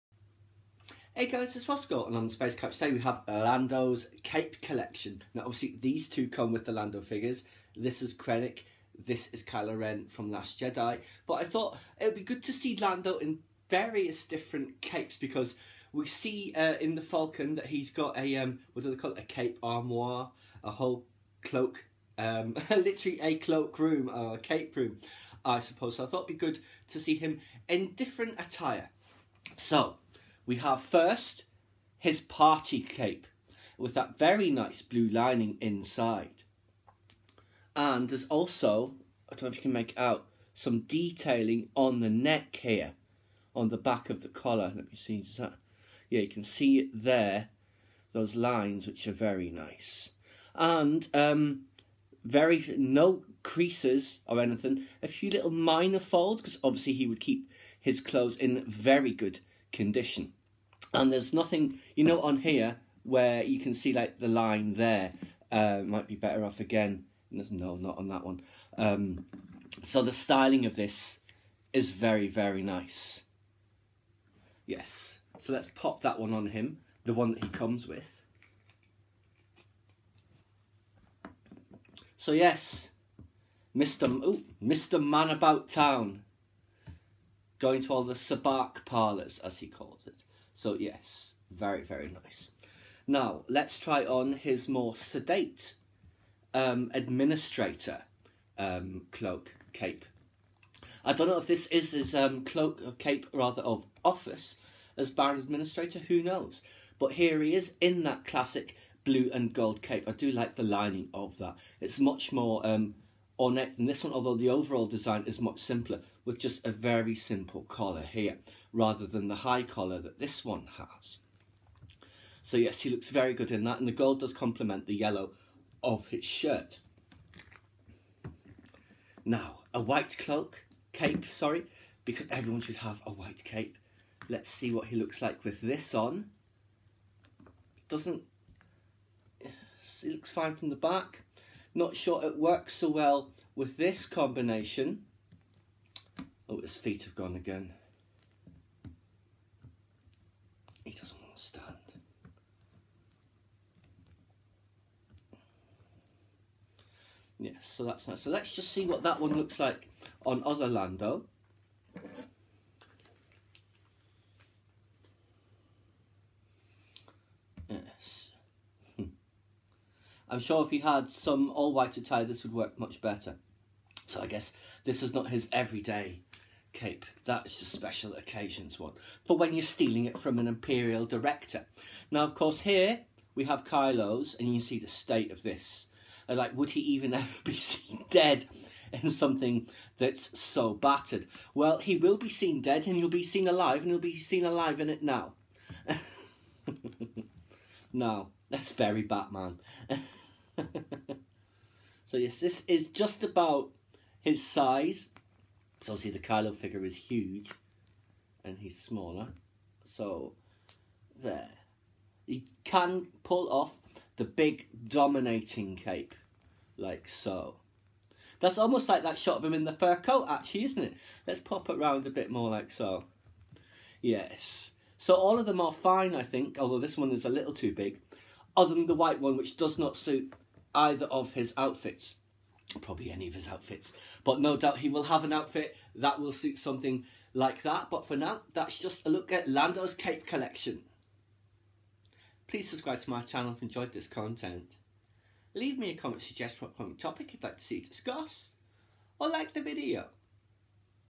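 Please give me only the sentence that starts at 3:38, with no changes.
That's almost like that shot of him in the fur coat, actually, isn't it?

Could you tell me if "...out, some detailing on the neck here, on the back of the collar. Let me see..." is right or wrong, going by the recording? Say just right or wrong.
right.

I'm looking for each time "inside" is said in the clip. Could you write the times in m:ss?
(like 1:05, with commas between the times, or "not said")
0:35.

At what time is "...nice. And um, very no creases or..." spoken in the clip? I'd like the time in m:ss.
0:49.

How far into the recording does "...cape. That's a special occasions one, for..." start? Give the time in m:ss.
2:56.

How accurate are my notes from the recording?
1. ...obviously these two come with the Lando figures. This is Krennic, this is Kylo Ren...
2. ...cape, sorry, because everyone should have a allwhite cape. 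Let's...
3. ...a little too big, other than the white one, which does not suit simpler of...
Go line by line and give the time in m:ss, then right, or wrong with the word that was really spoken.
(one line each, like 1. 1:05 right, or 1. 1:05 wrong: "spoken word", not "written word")
1. 0:05 right
2. 2:10 wrong: "white", not "allwhite"
3. 3:47 wrong: "either", not "simpler".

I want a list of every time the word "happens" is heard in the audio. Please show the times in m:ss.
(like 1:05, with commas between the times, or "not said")
not said.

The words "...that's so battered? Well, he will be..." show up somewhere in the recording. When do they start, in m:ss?
3:09.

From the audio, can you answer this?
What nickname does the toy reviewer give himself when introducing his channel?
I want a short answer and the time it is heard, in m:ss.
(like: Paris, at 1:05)
Space Coach, at 0:02.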